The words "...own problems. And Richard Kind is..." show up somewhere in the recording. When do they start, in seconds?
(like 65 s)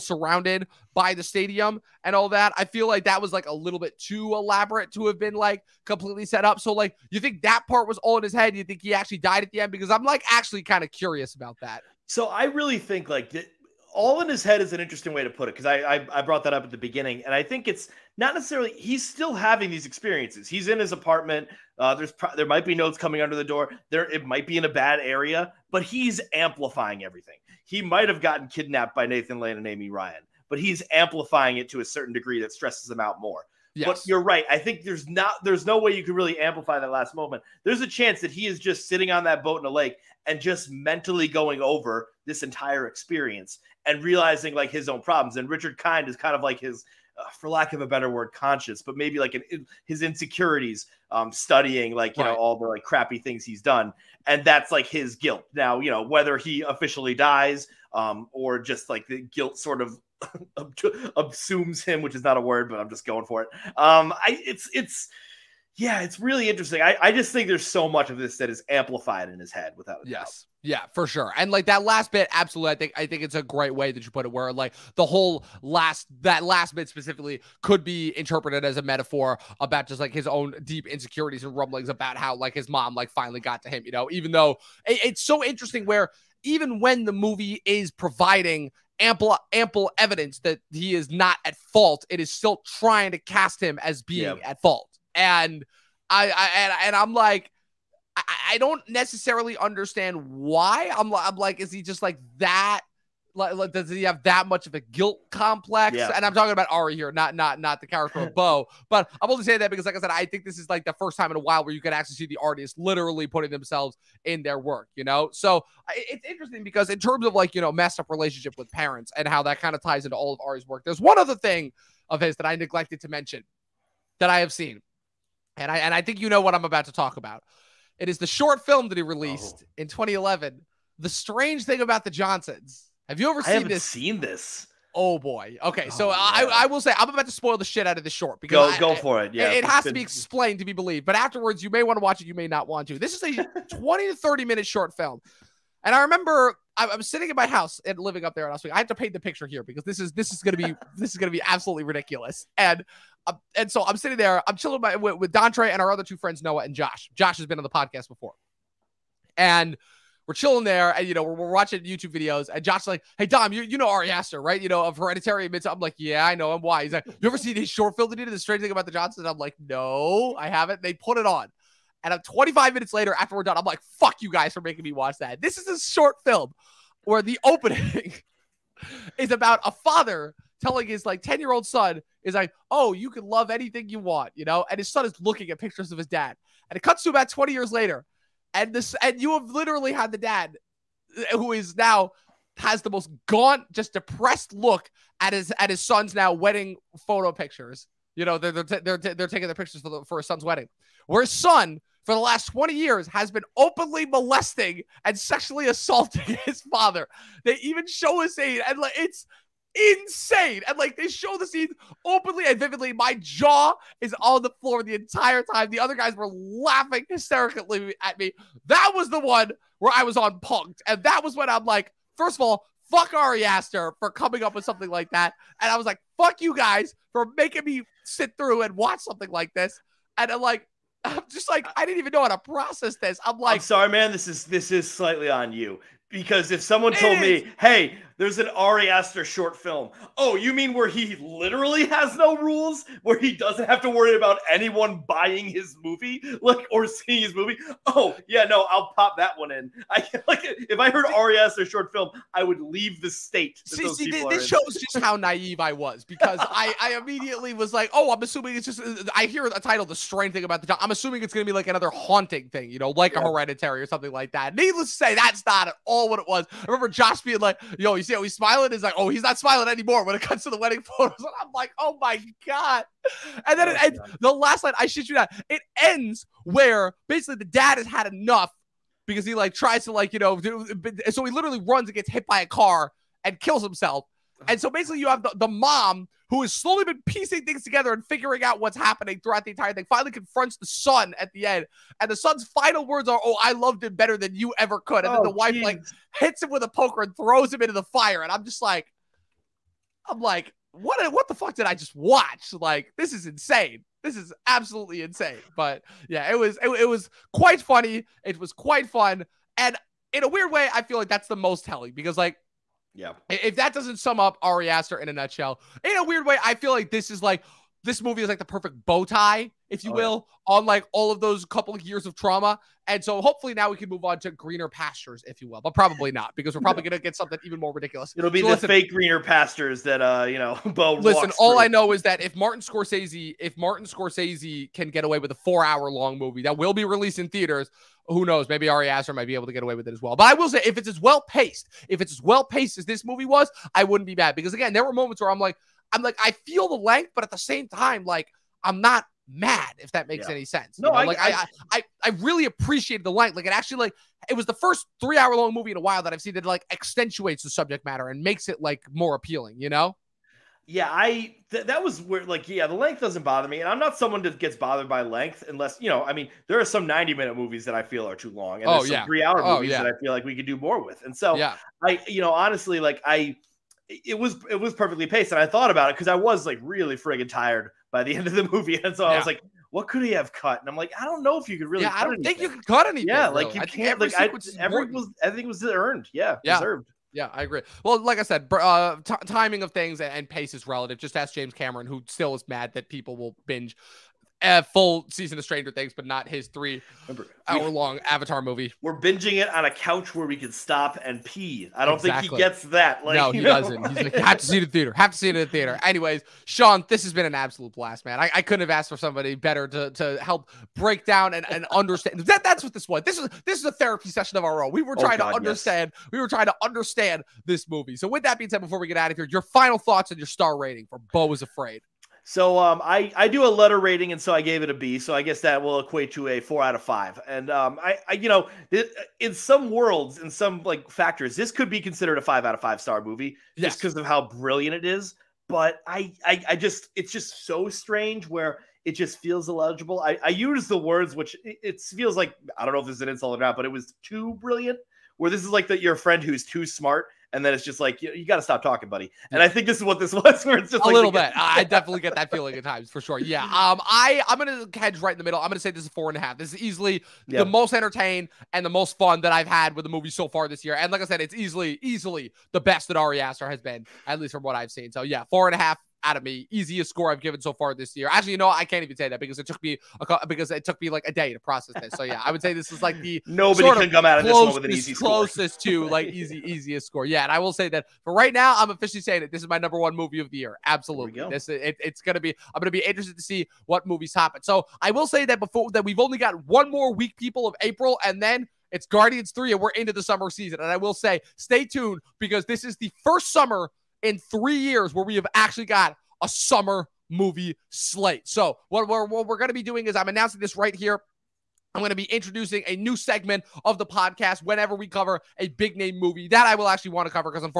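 44 s.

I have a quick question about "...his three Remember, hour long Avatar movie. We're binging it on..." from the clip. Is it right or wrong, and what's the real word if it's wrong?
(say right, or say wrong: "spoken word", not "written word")
right.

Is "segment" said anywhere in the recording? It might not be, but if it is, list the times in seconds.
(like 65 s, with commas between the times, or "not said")
502 s.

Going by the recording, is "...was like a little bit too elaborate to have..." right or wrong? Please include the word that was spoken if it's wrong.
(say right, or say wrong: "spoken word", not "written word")
right.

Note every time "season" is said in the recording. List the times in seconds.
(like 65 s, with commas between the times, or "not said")
395 s, 490 s.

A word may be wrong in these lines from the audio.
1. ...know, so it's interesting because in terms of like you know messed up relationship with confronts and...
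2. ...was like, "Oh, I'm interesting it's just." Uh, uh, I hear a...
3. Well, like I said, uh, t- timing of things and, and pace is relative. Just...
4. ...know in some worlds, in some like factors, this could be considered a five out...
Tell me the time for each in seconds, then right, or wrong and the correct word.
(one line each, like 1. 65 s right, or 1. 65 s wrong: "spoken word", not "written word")
1. 115 s wrong: "parents", not "confronts"
2. 257 s wrong: "assuming", not "interesting"
3. 387 s right
4. 428 s right.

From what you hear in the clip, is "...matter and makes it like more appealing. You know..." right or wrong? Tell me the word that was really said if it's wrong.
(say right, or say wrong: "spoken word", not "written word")
right.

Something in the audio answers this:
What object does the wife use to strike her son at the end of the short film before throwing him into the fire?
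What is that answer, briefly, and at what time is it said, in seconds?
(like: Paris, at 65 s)
a poker, at 296 s.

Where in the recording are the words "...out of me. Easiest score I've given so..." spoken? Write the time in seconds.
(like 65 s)
466 s.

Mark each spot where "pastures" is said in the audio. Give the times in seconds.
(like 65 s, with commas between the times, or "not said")
324 s, 329 s.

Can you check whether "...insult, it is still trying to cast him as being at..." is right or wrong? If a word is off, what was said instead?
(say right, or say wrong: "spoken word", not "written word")
wrong: "fault", not "insult".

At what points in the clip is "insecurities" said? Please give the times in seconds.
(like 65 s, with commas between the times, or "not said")
50 s, 80 s.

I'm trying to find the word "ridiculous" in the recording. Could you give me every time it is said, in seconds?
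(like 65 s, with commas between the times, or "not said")
151 s, 327 s.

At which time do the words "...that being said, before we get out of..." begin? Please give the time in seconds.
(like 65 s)
418 s.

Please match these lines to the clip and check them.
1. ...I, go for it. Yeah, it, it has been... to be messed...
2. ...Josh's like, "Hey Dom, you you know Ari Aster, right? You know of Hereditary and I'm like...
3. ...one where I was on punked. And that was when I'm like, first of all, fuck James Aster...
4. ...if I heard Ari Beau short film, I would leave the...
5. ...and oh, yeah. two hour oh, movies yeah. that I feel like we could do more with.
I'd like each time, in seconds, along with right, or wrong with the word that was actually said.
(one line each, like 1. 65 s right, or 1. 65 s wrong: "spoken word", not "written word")
1. 138 s wrong: "explained", not "messed"
2. 162 s right
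3. 219 s wrong: "Ari", not "James"
4. 250 s wrong: "Aster", not "Beau"
5. 368 s wrong: "three", not "two".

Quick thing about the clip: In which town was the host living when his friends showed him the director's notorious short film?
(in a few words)
Oswego.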